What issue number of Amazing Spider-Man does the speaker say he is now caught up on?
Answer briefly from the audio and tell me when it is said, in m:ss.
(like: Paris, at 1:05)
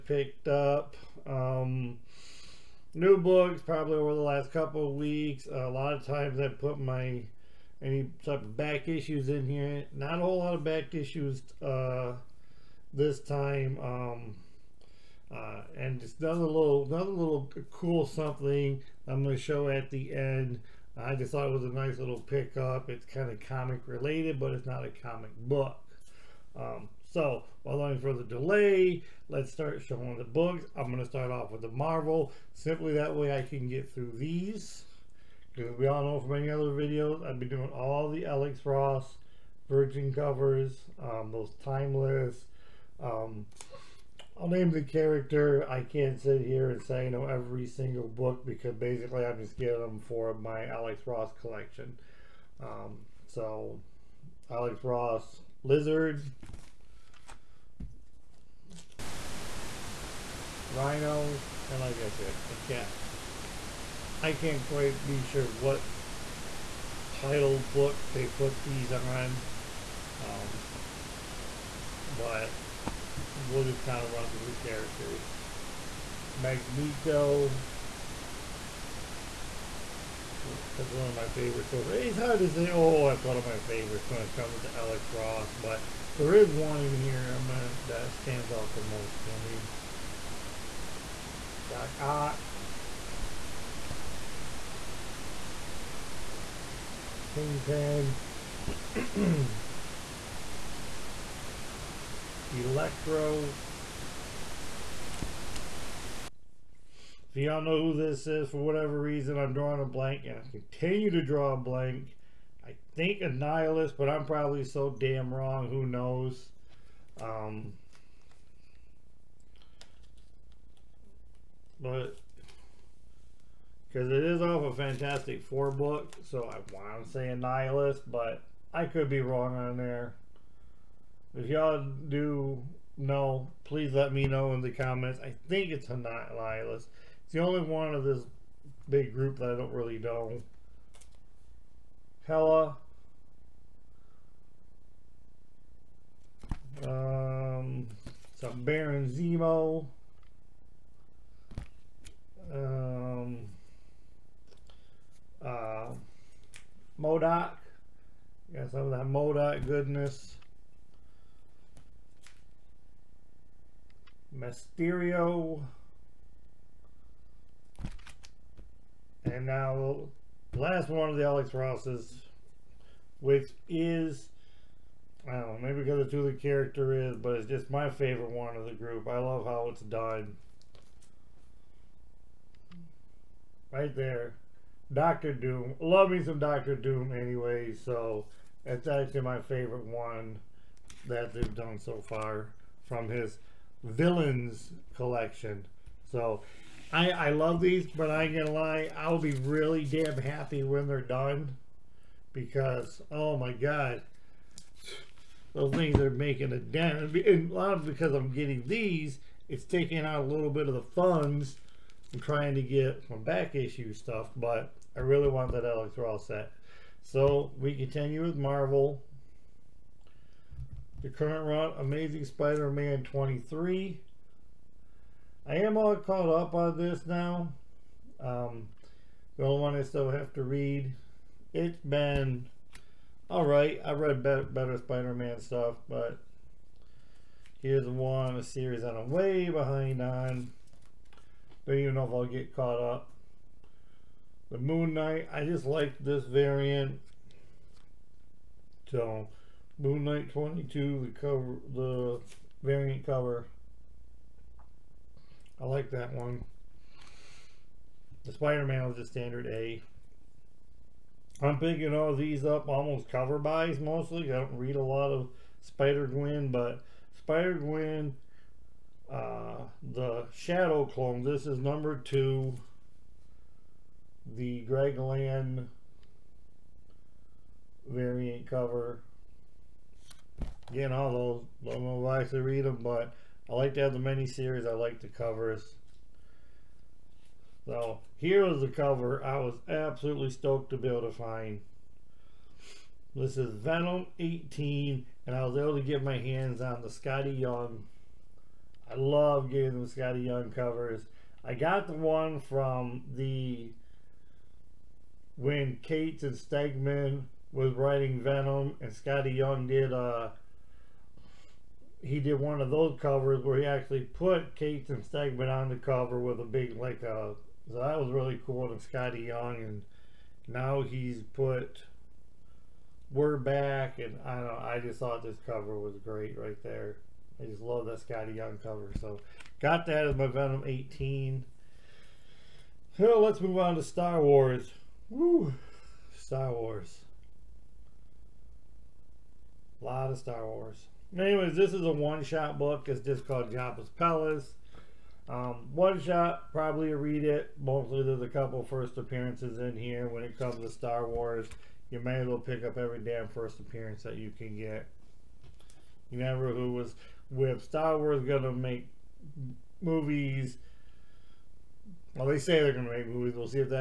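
23, at 3:41.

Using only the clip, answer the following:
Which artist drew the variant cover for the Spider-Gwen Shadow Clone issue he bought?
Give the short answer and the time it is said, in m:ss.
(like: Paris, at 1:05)
Greg Land, at 4:34.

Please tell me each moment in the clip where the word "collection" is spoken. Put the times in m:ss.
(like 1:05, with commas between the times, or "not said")
0:51, 3:14.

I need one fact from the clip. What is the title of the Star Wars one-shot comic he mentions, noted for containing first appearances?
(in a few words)
Jabba's Palace.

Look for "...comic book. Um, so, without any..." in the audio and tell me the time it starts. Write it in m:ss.
0:24.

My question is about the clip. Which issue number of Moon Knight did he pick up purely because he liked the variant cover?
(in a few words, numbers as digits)
22.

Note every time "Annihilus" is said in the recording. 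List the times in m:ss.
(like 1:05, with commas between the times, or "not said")
1:53, 2:07.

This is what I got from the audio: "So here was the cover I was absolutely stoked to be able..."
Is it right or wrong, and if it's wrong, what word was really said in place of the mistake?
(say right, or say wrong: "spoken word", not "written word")
right.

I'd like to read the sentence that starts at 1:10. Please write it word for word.
Um, but we'll just kind of run through the characters.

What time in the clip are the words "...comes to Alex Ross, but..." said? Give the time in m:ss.
1:24.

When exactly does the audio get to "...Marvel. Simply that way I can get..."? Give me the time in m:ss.
0:31.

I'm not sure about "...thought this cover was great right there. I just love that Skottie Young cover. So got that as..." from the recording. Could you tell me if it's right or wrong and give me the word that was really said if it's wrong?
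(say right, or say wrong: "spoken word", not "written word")
right.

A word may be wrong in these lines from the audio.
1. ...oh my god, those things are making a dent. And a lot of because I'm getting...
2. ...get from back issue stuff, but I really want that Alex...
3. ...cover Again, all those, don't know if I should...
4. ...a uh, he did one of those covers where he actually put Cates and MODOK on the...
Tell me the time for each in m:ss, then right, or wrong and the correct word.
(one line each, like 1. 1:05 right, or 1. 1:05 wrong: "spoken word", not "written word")
1. 3:23 right
2. 3:32 right
3. 4:38 right
4. 5:09 wrong: "Stegman", not "MODOK".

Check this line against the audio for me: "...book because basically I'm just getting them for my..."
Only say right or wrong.
right.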